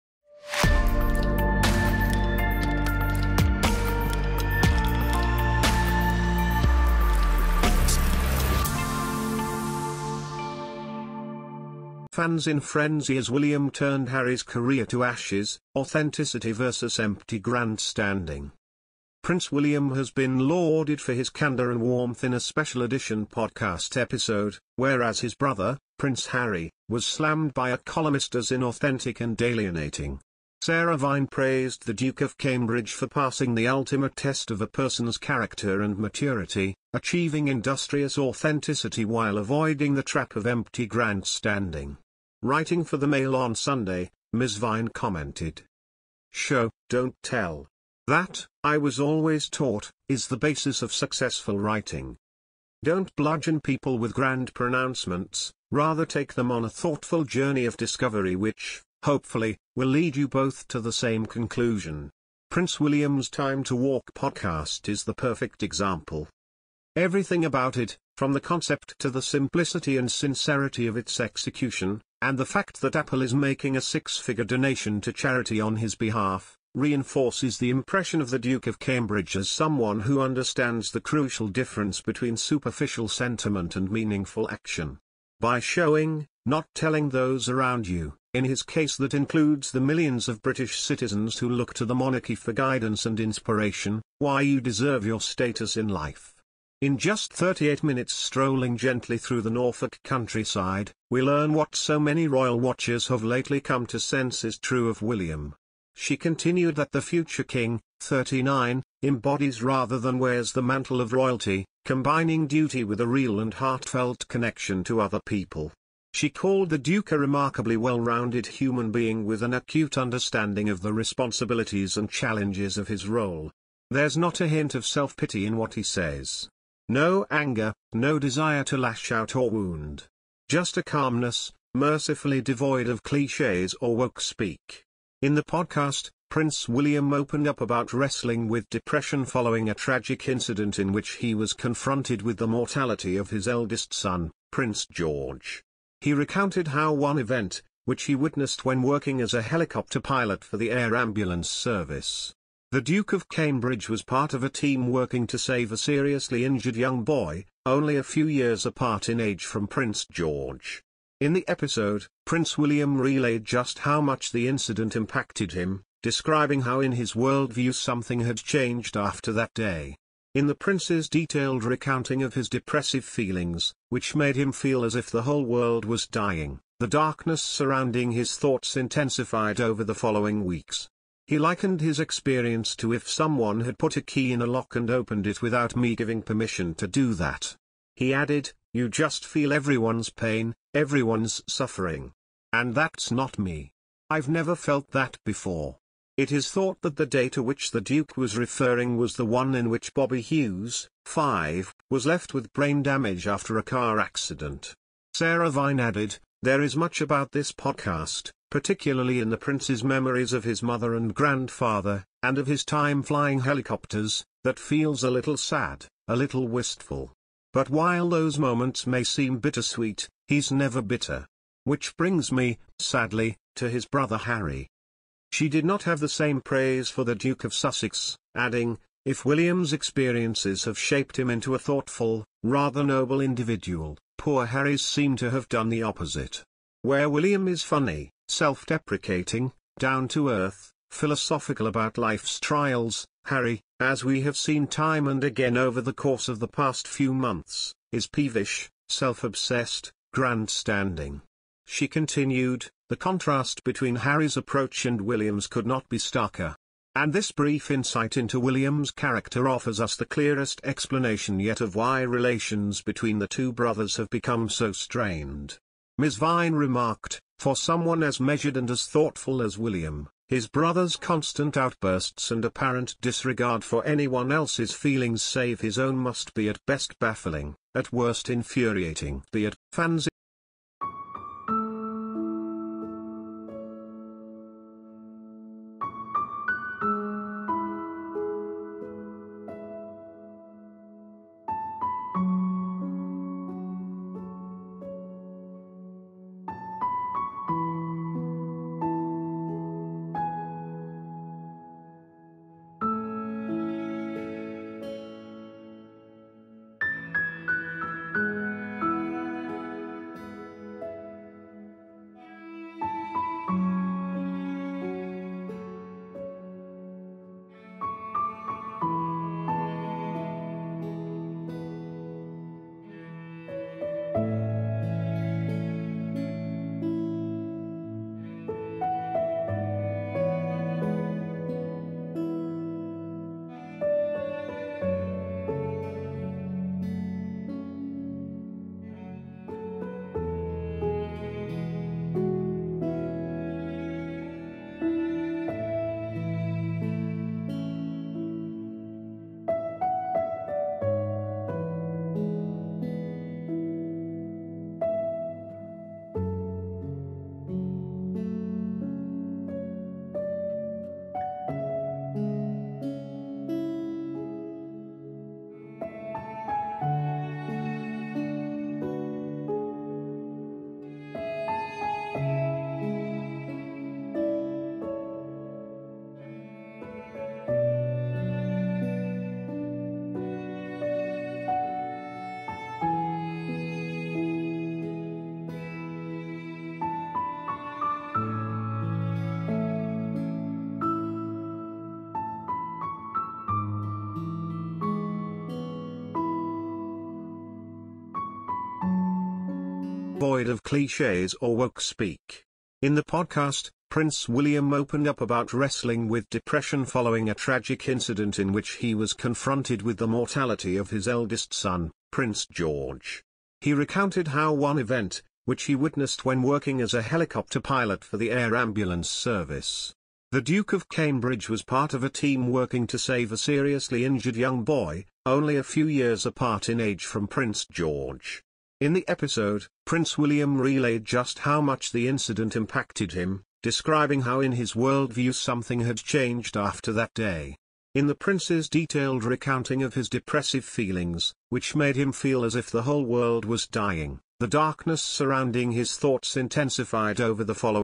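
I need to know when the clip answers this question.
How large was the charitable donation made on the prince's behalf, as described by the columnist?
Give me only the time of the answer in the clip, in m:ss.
1:13.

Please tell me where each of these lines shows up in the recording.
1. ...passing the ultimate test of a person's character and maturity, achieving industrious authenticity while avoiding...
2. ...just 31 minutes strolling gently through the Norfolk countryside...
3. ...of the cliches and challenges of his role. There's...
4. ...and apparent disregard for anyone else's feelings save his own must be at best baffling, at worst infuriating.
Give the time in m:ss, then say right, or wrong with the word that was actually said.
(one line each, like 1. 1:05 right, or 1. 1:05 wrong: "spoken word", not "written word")
1. 0:33 right
2. 1:36 wrong: "38", not "31"
3. 2:00 wrong: "responsibilities", not "cliches"
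4. 4:32 right.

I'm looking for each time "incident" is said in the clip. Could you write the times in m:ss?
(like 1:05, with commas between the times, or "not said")
2:20, 2:44, 6:47, 7:12.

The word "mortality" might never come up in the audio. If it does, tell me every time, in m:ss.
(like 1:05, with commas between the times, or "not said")
2:22, 6:50.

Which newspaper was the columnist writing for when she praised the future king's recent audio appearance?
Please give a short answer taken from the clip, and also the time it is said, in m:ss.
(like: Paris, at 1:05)
Mail on Sunday, at 0:43.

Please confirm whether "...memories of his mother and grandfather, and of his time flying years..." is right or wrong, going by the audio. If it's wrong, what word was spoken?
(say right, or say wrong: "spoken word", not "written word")
wrong: "helicopters", not "years".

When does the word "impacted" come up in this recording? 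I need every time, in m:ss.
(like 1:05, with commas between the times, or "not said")
2:44, 7:12.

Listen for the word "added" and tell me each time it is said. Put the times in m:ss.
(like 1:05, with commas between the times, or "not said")
3:08, 3:25.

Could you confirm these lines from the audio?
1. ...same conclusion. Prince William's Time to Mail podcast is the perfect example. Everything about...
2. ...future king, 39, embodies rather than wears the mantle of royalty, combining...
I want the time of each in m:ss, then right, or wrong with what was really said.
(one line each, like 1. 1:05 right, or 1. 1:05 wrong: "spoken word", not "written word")
1. 1:00 wrong: "Walk", not "Mail"
2. 1:47 right.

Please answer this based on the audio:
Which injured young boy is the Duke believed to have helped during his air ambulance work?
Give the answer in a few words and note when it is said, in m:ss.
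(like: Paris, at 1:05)
Bobby Hughes, at 3:19.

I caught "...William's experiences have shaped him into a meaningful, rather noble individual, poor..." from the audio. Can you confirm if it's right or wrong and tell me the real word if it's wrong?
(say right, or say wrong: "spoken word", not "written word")
wrong: "thoughtful", not "meaningful".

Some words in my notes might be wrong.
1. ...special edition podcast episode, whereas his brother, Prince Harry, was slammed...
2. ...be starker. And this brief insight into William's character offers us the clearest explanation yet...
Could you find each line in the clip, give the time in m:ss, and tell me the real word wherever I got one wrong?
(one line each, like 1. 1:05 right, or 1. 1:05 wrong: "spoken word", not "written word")
1. 0:22 right
2. 4:15 right.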